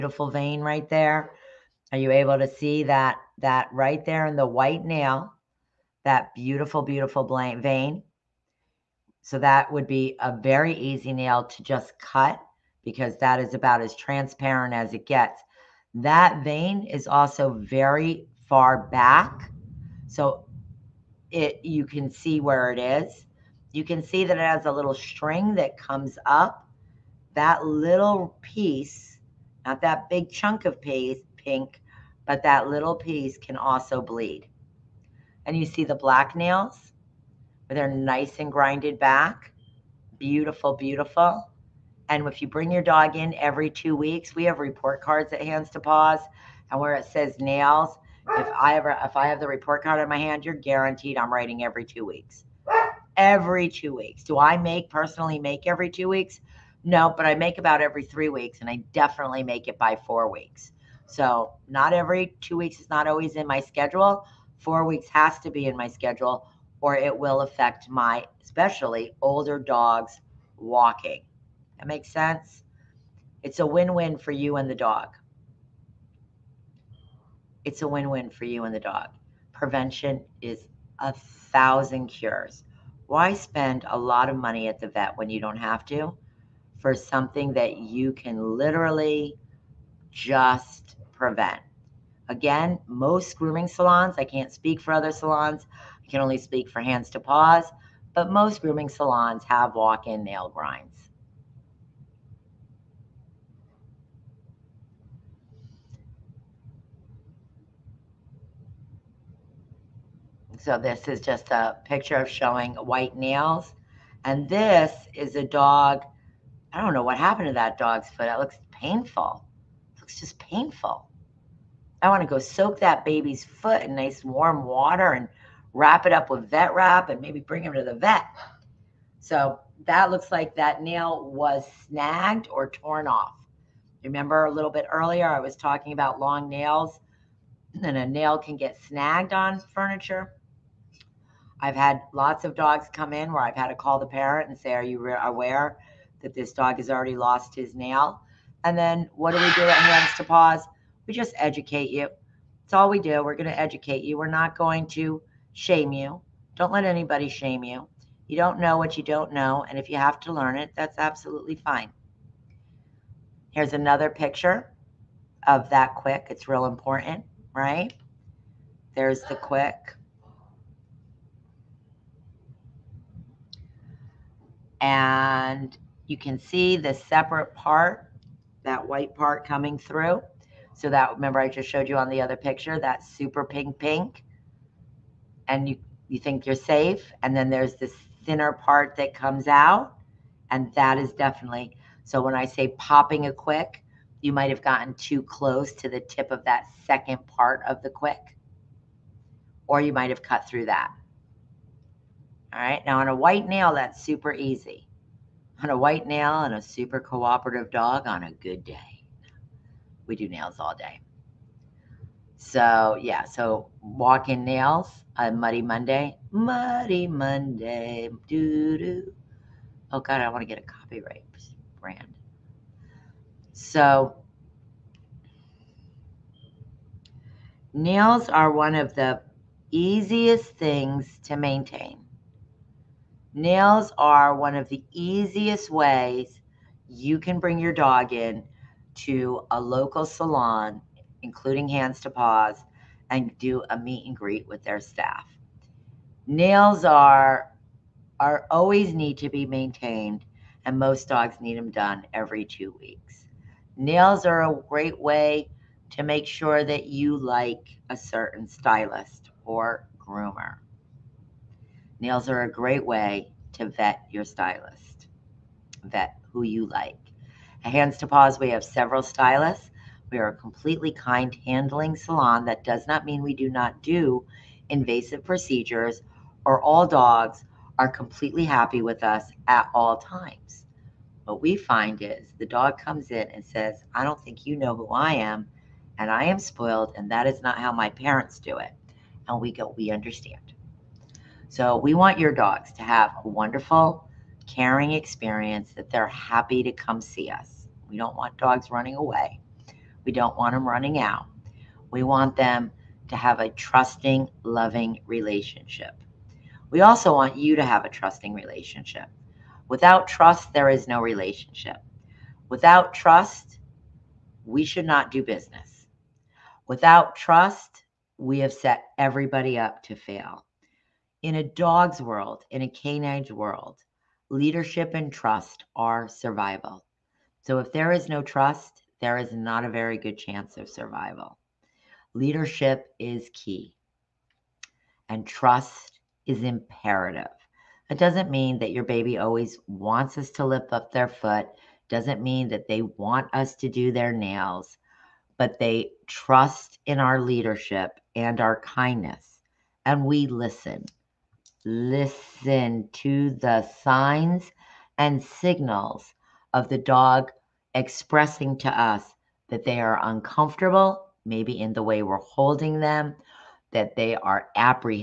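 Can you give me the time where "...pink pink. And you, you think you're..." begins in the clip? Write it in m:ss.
3:03.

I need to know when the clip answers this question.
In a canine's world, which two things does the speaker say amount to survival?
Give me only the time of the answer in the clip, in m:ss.
5:24.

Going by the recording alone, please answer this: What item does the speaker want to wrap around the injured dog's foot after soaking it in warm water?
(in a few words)
vet wrap.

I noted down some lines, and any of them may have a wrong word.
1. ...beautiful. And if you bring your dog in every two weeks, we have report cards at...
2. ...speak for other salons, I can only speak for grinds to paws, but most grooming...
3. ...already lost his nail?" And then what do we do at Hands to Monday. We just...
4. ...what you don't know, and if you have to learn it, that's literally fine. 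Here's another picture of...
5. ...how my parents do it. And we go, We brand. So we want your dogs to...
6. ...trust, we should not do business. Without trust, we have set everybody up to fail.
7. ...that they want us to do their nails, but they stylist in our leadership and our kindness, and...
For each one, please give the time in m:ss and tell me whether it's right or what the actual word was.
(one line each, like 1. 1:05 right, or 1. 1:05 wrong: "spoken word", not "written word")
1. 0:40 right
2. 1:34 wrong: "hands", not "grinds"
3. 2:26 wrong: "Paws", not "Monday"
4. 2:38 wrong: "absolutely", not "literally"
5. 4:47 wrong: "understand", not "brand"
6. 5:12 right
7. 5:42 wrong: "trust", not "stylist".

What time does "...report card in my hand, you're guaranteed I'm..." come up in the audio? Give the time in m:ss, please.
0:49.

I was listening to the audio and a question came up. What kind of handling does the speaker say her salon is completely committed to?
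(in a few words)
kind handling.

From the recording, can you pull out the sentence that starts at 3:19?
Or you might have cut through that.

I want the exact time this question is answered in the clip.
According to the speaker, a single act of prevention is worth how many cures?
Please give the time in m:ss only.
1:20.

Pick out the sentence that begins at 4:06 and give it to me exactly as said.
Nails are are always need to be maintained, and most dogs need them done every two weeks.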